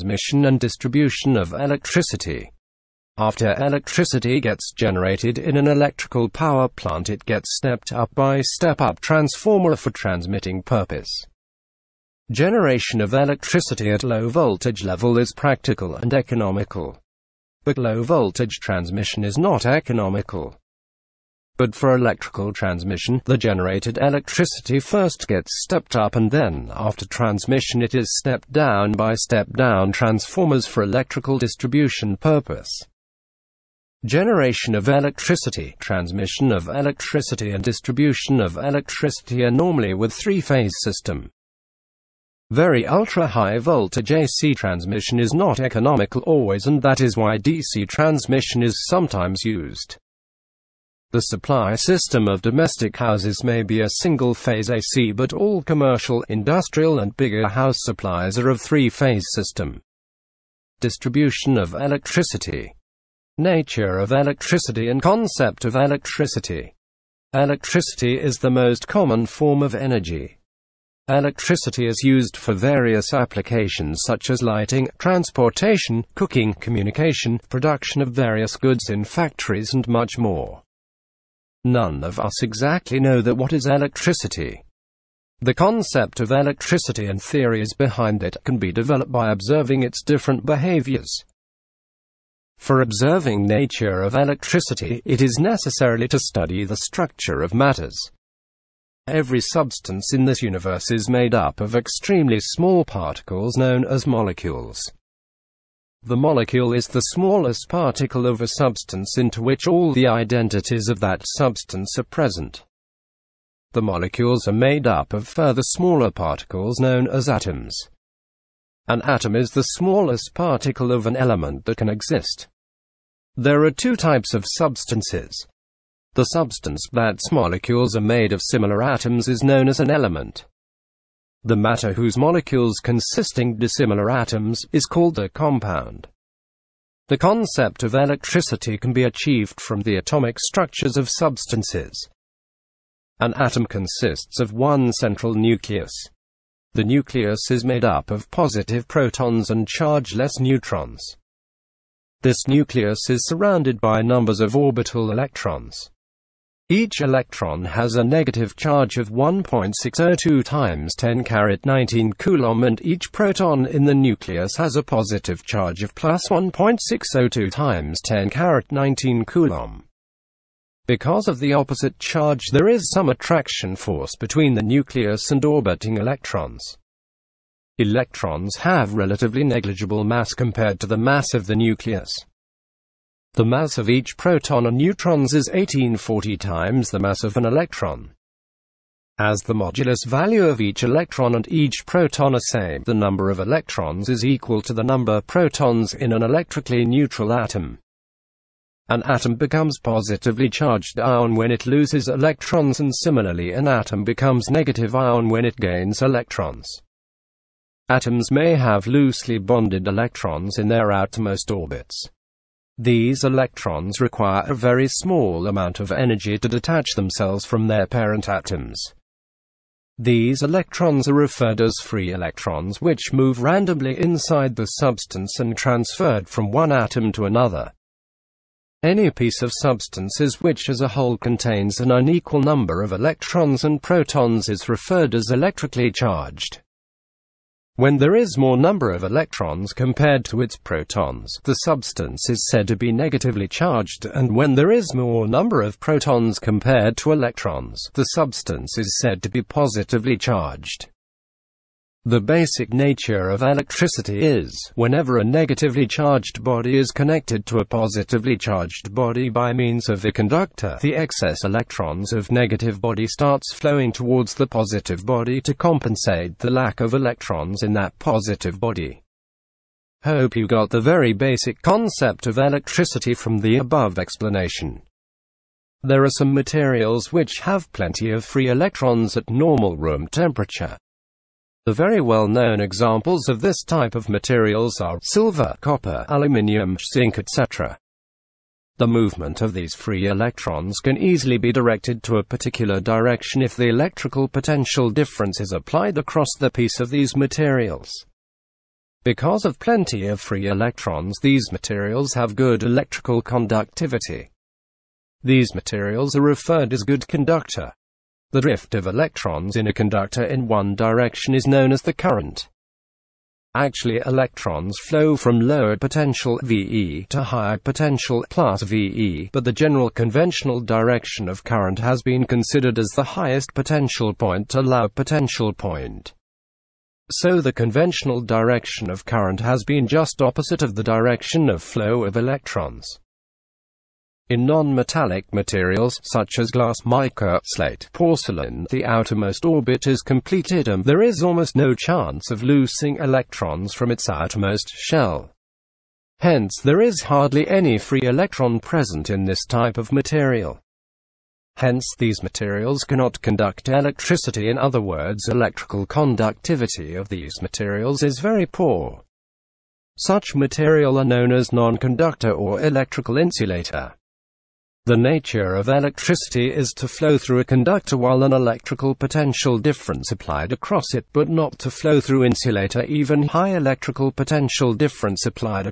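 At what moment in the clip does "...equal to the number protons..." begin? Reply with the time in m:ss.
3:14.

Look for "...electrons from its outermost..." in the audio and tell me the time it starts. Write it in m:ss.
5:42.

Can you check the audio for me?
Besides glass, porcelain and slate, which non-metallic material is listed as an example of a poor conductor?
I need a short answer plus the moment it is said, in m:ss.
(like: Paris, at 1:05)
mica, at 5:36.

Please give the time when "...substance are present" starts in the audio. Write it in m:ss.
1:51.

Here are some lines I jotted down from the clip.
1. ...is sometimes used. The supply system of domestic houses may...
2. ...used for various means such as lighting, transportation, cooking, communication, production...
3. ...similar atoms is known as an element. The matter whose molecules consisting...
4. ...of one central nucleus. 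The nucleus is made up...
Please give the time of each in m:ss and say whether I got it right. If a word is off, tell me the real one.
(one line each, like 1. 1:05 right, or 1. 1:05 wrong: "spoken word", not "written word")
1. 0:48 right
2. 1:12 wrong: "applications", not "means"
3. 2:08 right
4. 2:24 right.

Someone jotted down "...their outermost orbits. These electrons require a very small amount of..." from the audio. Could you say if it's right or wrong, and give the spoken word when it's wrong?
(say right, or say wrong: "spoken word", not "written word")
right.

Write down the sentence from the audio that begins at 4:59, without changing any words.
Because of plenty of free electrons these materials have good electrical conductivity.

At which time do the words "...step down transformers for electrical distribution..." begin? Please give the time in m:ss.
0:29.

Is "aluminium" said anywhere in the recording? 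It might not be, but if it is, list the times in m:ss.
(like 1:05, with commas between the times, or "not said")
4:46.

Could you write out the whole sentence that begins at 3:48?
Any piece of substance which as a whole contains an unequal number of electrons and protons is referred as electrically charged.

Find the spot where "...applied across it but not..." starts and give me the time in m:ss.
6:10.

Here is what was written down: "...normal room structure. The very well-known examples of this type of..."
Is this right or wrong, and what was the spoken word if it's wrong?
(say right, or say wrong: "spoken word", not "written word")
wrong: "temperature", not "structure".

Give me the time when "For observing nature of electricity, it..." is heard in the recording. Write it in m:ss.
1:32.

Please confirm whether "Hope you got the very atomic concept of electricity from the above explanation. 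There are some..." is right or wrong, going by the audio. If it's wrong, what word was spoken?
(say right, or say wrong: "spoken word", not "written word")
wrong: "basic", not "atomic".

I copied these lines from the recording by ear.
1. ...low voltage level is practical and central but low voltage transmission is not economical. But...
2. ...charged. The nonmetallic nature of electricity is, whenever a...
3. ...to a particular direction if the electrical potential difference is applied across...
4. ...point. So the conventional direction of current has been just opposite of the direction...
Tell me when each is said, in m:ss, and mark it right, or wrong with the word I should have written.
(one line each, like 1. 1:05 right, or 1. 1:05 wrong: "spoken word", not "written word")
1. 0:14 wrong: "economical", not "central"
2. 4:10 wrong: "basic", not "nonmetallic"
3. 4:52 right
4. 5:25 right.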